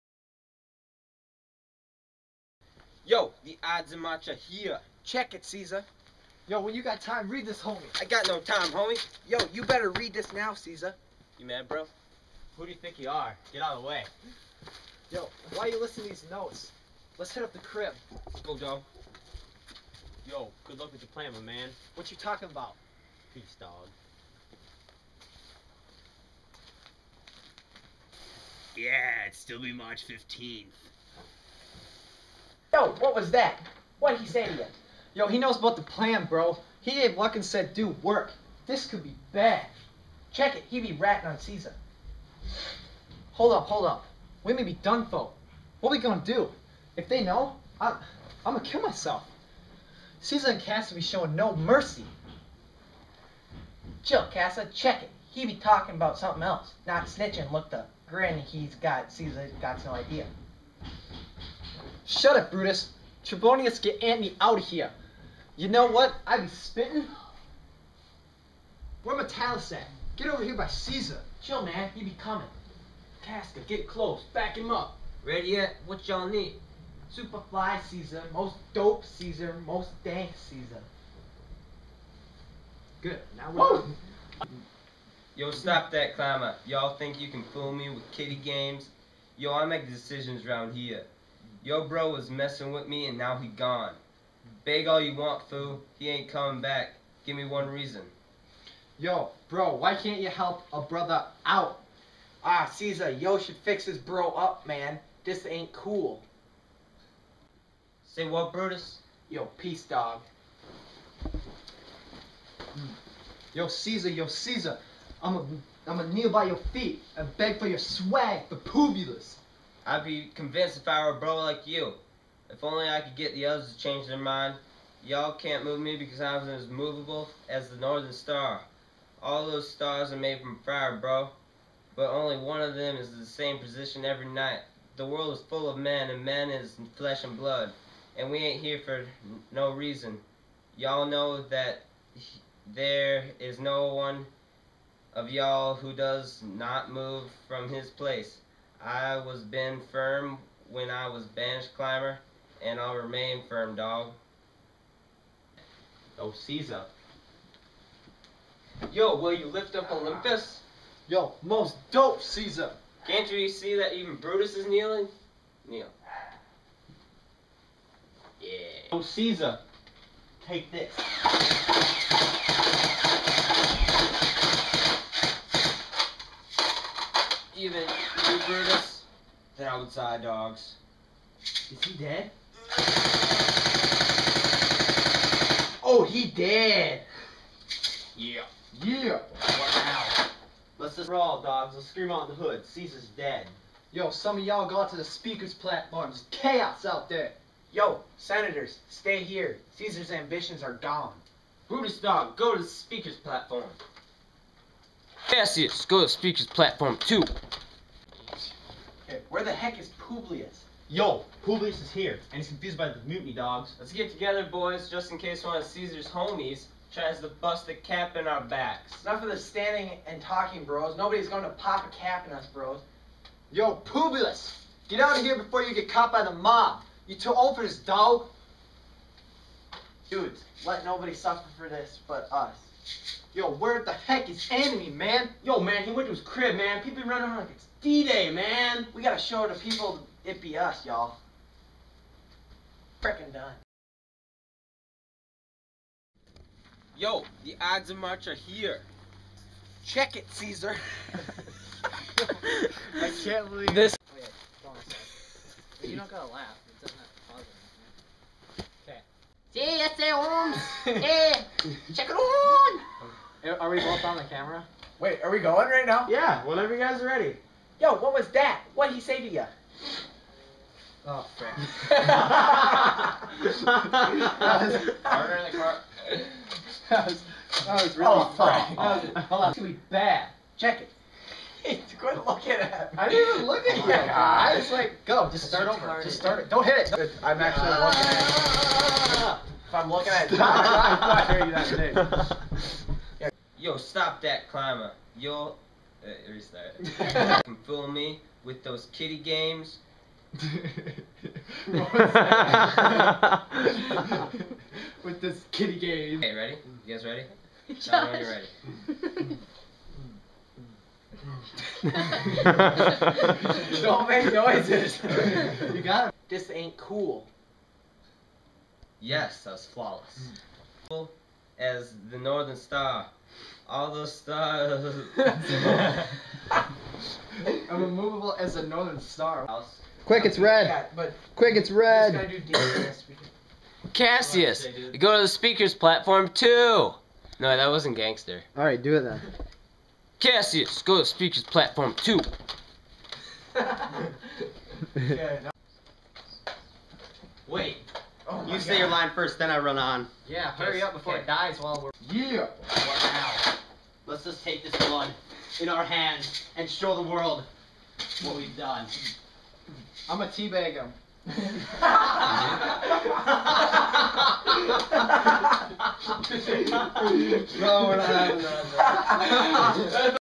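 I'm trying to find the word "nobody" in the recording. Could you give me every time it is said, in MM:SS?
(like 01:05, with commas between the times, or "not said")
03:40, 03:50.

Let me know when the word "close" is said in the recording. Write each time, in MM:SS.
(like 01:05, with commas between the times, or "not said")
01:13.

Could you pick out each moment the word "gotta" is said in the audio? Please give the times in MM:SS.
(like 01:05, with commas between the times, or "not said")
03:59, 04:16.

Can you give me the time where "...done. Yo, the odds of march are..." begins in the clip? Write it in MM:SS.
04:03.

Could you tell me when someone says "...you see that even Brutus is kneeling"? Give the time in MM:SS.
02:43.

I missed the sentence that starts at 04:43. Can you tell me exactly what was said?
I was like, go, just start over.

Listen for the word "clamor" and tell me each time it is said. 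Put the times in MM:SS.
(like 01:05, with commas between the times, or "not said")
01:26.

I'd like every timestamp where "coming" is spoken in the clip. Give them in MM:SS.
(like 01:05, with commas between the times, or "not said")
01:12, 01:36.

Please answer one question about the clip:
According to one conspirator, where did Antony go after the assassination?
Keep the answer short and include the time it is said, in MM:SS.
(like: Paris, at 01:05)
his crib, at 03:56.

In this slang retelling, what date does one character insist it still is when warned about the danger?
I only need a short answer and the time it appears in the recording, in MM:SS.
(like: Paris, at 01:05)
March 15th, at 00:29.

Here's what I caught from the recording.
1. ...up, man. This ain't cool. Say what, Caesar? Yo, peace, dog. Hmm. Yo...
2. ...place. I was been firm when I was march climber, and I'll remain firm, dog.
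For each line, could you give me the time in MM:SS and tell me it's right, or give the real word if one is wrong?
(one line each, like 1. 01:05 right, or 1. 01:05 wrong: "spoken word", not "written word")
1. 01:44 wrong: "Brutus", not "Caesar"
2. 02:27 wrong: "bench", not "march".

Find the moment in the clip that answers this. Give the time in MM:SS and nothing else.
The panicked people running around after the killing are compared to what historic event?
03:57.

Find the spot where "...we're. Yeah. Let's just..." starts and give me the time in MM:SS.
05:51.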